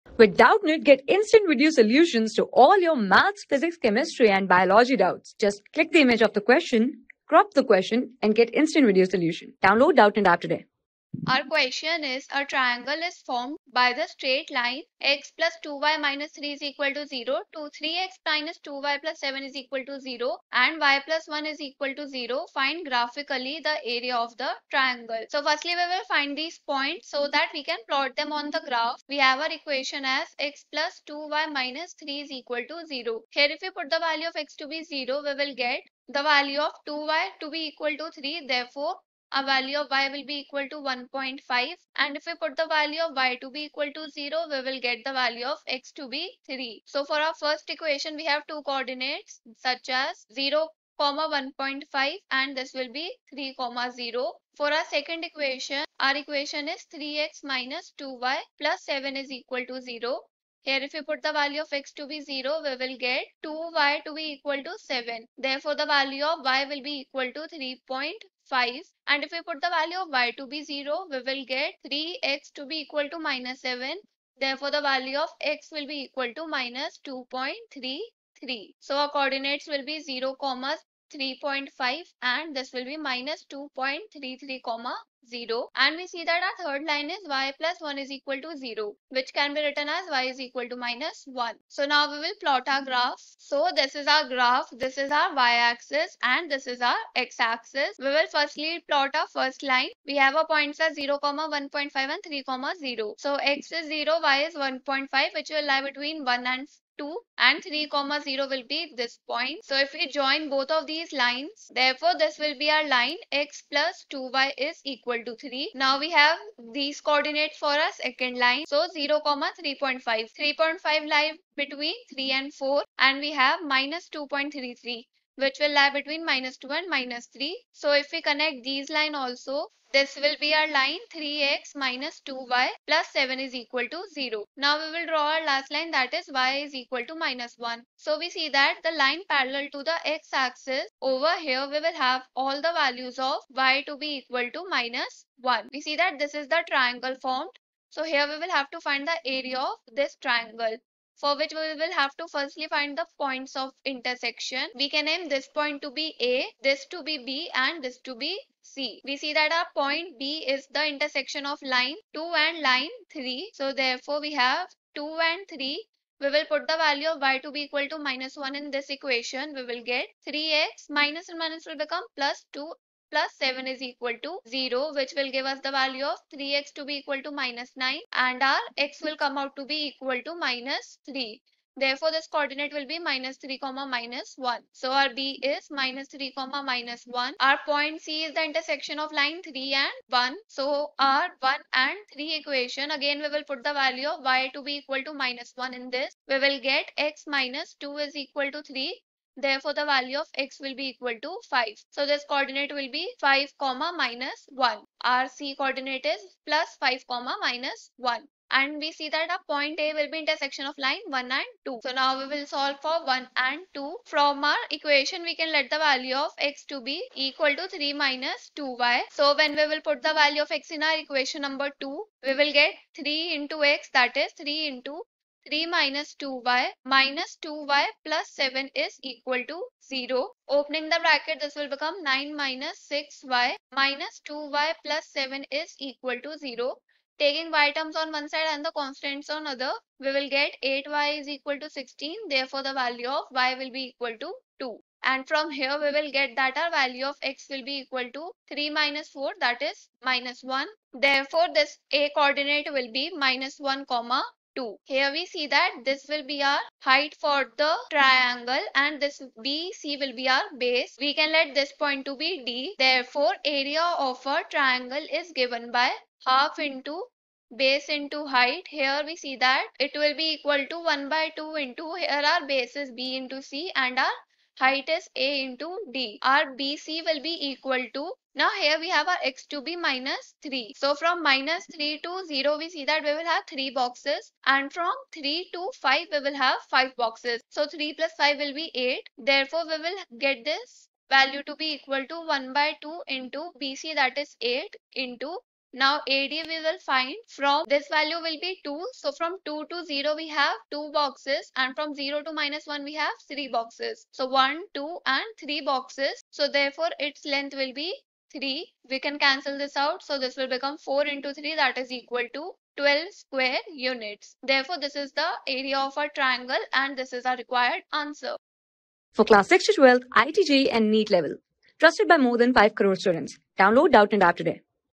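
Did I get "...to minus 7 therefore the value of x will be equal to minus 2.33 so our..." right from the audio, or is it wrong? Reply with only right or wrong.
right.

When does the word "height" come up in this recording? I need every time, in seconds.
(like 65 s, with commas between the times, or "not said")
256 s, 268 s, 274 s.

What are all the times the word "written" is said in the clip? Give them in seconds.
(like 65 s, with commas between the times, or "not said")
89 s.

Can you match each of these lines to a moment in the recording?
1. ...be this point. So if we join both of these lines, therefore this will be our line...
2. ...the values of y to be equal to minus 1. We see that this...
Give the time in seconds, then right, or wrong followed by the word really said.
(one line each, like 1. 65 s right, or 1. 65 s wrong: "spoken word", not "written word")
1. 108 s right
2. 142 s right.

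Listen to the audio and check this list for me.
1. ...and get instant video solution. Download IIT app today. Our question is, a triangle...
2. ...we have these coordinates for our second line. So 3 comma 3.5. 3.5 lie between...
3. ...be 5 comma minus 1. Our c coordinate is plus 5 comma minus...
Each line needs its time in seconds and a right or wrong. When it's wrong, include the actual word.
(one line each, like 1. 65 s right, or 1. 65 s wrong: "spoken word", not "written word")
1. 8 s wrong: "Doubtnut", not "IIT"
2. 115 s wrong: "0", not "3"
3. 202 s right.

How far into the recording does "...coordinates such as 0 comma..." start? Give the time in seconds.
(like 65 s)
48 s.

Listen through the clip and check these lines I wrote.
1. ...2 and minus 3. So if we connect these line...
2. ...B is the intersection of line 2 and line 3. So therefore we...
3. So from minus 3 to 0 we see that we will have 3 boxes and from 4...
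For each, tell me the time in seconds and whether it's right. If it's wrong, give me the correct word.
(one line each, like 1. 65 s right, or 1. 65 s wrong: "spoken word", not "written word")
1. 126 s right
2. 160 s right
3. 280 s wrong: "3", not "4".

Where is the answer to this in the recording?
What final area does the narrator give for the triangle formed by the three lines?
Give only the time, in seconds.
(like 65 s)
312 s.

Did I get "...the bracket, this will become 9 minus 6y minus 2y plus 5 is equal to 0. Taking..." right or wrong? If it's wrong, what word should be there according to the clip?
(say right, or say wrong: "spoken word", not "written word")
wrong: "7", not "5".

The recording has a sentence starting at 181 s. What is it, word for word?
Therefore, this coordinate will be minus 3 comma minus 1.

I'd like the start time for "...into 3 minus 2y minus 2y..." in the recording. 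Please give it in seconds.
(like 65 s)
224 s.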